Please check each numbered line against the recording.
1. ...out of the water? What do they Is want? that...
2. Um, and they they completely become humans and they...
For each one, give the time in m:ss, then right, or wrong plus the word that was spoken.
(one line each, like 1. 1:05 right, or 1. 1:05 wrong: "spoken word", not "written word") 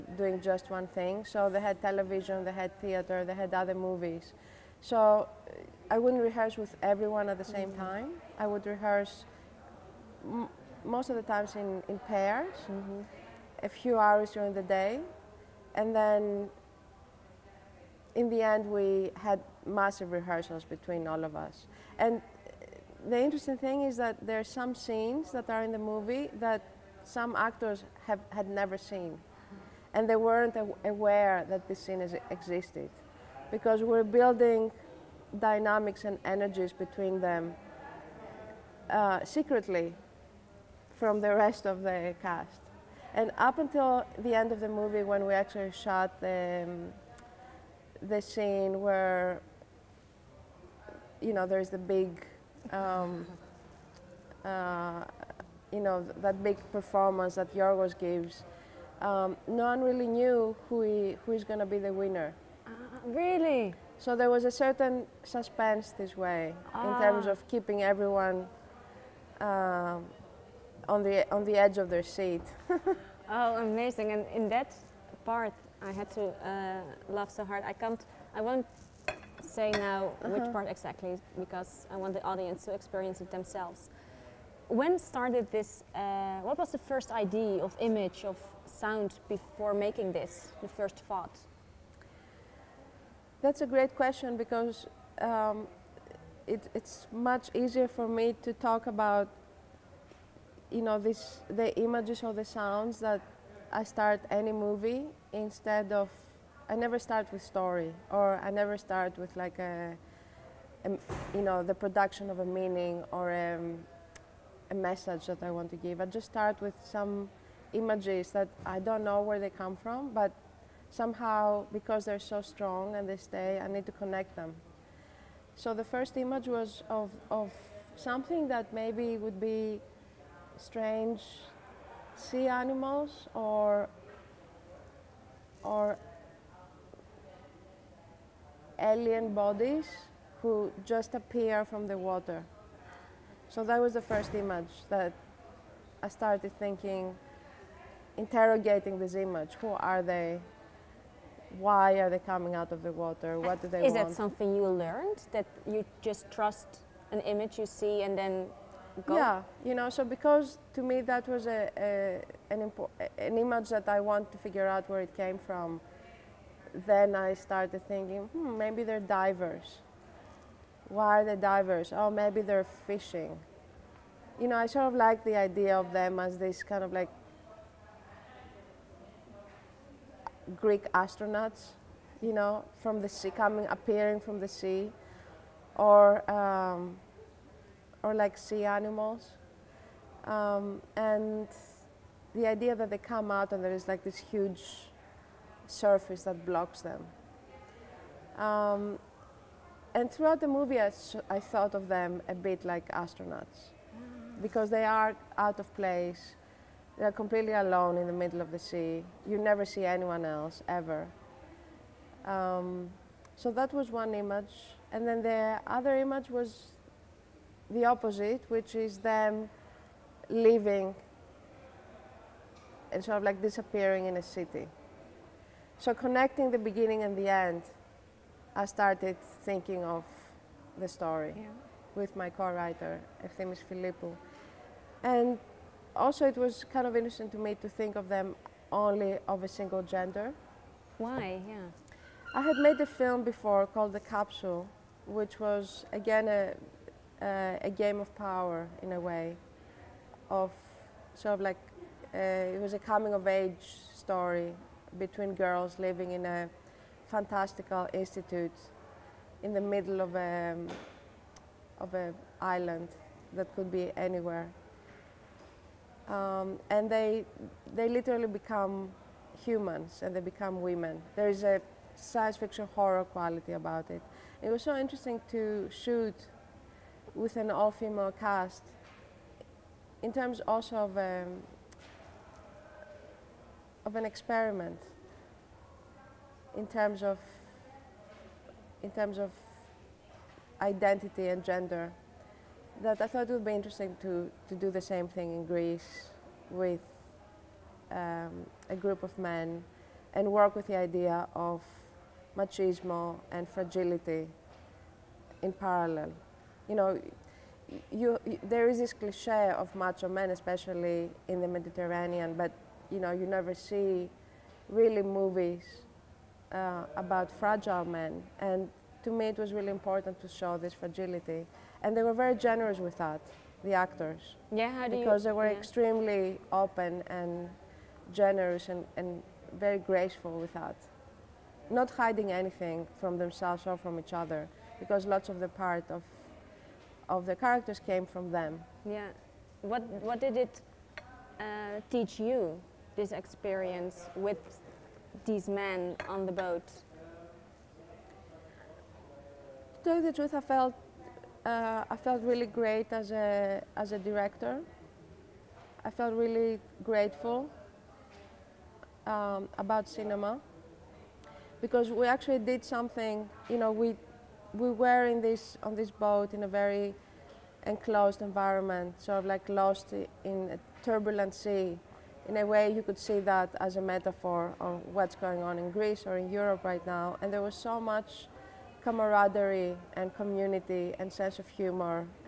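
1. 2:32 right
2. 4:26 wrong: "literally", not "completely".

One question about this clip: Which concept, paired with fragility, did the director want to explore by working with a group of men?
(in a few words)
Machismo.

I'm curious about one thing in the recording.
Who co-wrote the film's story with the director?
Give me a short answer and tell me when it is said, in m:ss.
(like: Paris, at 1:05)
Efthymis Filippou, at 3:53.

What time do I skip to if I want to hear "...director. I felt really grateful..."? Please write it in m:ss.
5:53.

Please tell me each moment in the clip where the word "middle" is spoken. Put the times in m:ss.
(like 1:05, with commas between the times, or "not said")
3:28, 4:19.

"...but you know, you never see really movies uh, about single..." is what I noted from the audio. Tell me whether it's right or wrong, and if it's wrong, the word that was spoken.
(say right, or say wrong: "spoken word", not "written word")
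wrong: "fragile", not "single".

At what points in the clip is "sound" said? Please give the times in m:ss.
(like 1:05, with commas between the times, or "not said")
1:28, 1:42.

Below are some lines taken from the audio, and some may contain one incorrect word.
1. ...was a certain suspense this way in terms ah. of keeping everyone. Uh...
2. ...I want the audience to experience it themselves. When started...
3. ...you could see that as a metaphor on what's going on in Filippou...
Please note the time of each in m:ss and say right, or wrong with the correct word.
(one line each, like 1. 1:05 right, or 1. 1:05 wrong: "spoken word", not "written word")
1. 1:04 right
2. 1:21 right
3. 6:12 wrong: "Greece", not "Filippou".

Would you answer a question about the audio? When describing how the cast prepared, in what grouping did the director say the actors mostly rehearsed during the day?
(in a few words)
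In pairs.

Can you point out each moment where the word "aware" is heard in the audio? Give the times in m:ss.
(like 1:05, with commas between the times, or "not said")
0:30.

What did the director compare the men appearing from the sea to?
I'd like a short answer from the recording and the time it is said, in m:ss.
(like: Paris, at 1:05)
Greek astronauts, at 3:00.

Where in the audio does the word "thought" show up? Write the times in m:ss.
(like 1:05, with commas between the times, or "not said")
1:31, 3:21, 4:53.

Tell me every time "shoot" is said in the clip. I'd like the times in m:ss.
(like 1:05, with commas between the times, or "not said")
4:35.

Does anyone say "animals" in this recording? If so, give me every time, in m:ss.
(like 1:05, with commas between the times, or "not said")
2:12, 3:08.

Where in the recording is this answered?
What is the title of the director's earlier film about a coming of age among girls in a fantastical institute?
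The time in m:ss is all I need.
4:03.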